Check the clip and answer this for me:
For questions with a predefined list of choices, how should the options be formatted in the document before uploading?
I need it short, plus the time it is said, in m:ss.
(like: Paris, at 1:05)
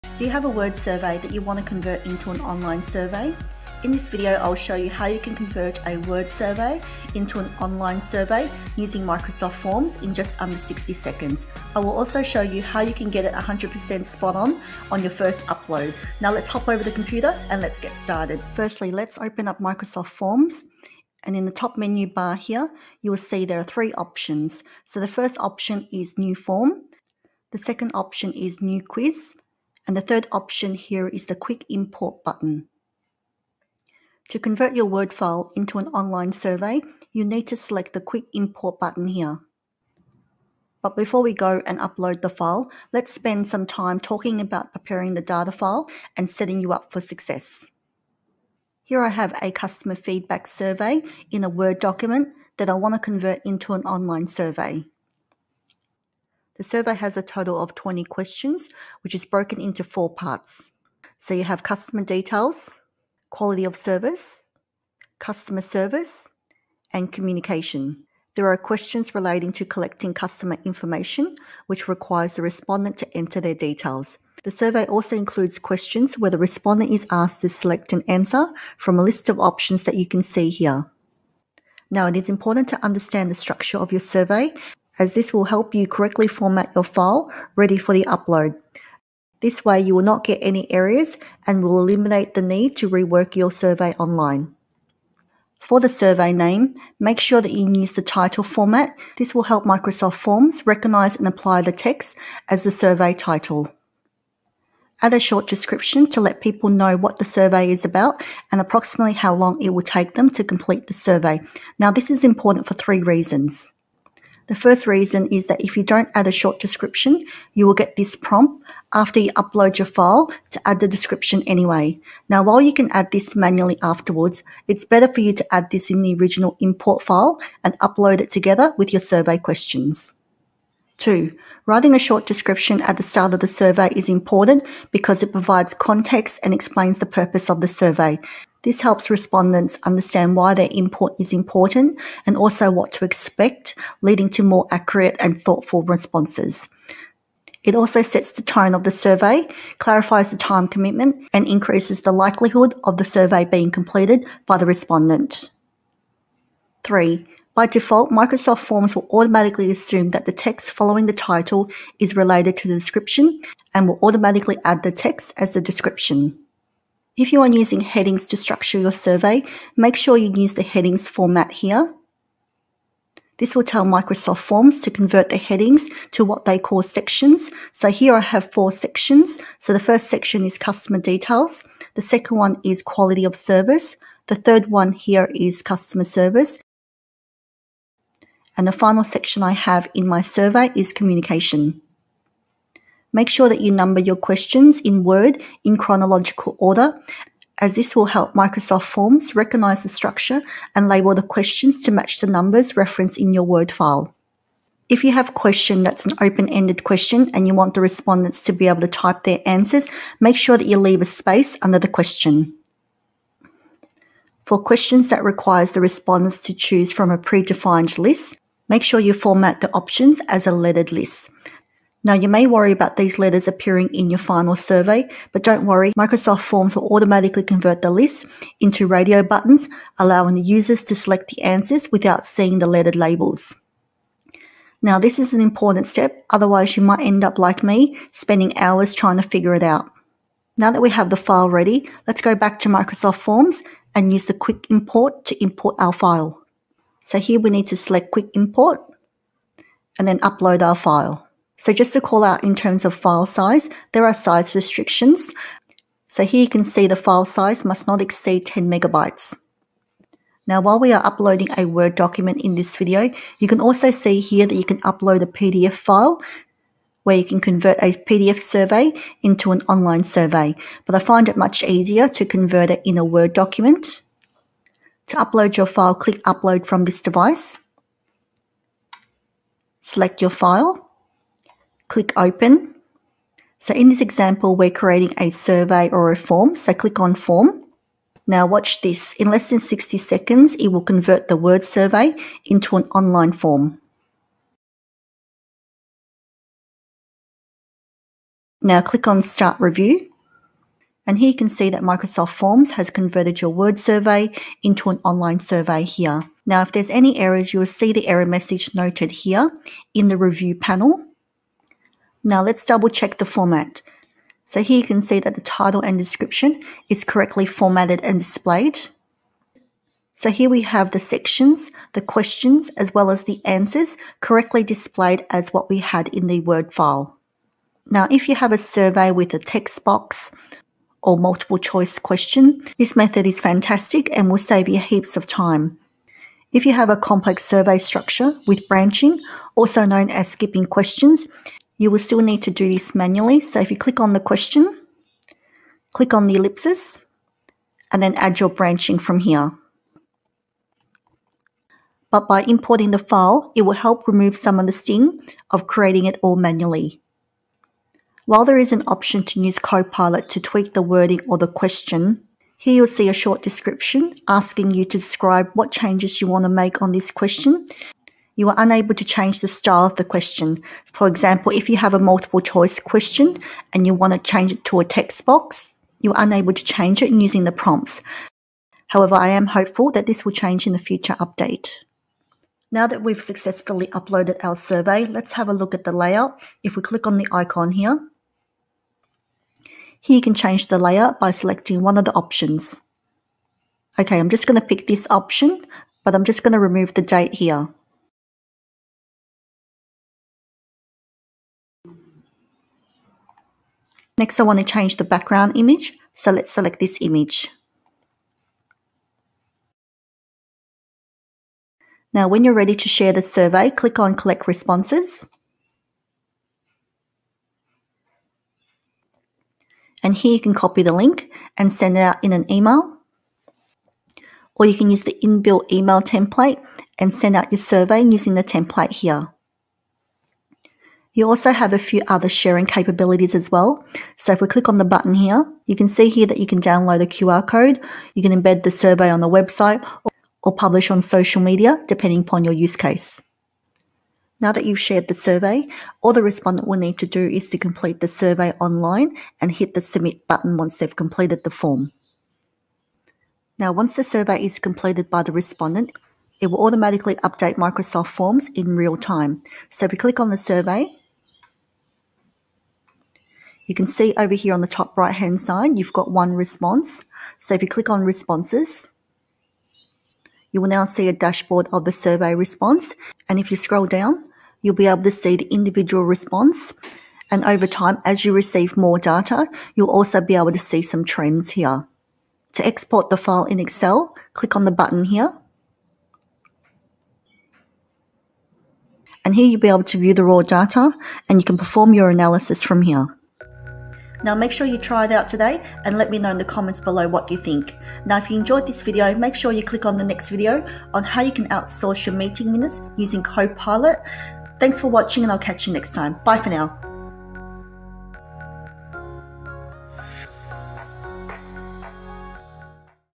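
As a lettered list, at 3:40.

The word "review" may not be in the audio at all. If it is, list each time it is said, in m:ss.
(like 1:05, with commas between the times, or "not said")
4:59, 5:10.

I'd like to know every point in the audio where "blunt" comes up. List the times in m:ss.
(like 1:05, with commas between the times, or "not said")
not said.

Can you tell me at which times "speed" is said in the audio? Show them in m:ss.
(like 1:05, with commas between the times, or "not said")
not said.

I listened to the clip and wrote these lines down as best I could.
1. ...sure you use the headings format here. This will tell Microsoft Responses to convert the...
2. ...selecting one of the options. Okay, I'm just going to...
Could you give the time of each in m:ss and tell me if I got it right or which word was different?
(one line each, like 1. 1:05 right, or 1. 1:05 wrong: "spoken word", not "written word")
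1. 2:49 wrong: "Forms", not "Responses"
2. 6:31 right.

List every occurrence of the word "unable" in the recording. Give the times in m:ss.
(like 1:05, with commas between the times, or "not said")
6:08, 6:16.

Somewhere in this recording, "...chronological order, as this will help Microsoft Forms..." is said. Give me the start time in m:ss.
3:15.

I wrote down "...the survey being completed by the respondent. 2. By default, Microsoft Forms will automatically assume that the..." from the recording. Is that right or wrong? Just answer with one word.
wrong.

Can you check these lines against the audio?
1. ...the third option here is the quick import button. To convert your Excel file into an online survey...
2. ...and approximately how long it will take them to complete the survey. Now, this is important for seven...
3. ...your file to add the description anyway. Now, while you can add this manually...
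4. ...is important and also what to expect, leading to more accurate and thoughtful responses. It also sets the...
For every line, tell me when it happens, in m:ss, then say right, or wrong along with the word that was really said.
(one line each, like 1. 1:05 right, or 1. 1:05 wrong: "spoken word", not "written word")
1. 0:29 wrong: "Word", not "Excel"
2. 1:48 wrong: "three", not "seven"
3. 1:59 right
4. 2:21 right.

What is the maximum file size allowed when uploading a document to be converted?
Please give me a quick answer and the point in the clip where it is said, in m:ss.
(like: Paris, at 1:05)
10 megabytes, at 4:18.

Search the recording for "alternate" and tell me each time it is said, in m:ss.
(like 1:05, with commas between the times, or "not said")
not said.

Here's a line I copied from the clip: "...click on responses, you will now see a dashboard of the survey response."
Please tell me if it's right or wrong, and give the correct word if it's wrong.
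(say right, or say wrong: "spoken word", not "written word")
right.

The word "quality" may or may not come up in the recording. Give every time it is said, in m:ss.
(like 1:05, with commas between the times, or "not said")
1:03, 3:02.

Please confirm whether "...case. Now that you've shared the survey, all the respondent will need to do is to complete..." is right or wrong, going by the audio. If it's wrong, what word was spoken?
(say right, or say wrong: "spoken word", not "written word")
right.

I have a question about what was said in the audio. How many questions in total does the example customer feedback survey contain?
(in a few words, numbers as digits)
20.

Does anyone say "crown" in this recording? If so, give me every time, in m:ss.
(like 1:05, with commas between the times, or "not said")
not said.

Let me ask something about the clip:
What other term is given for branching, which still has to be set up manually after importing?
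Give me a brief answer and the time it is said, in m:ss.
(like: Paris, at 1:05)
Skipping questions, at 5:40.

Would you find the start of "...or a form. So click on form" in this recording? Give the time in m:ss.
4:45.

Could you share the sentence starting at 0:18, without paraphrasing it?
Firstly, let's open up Microsoft Forms.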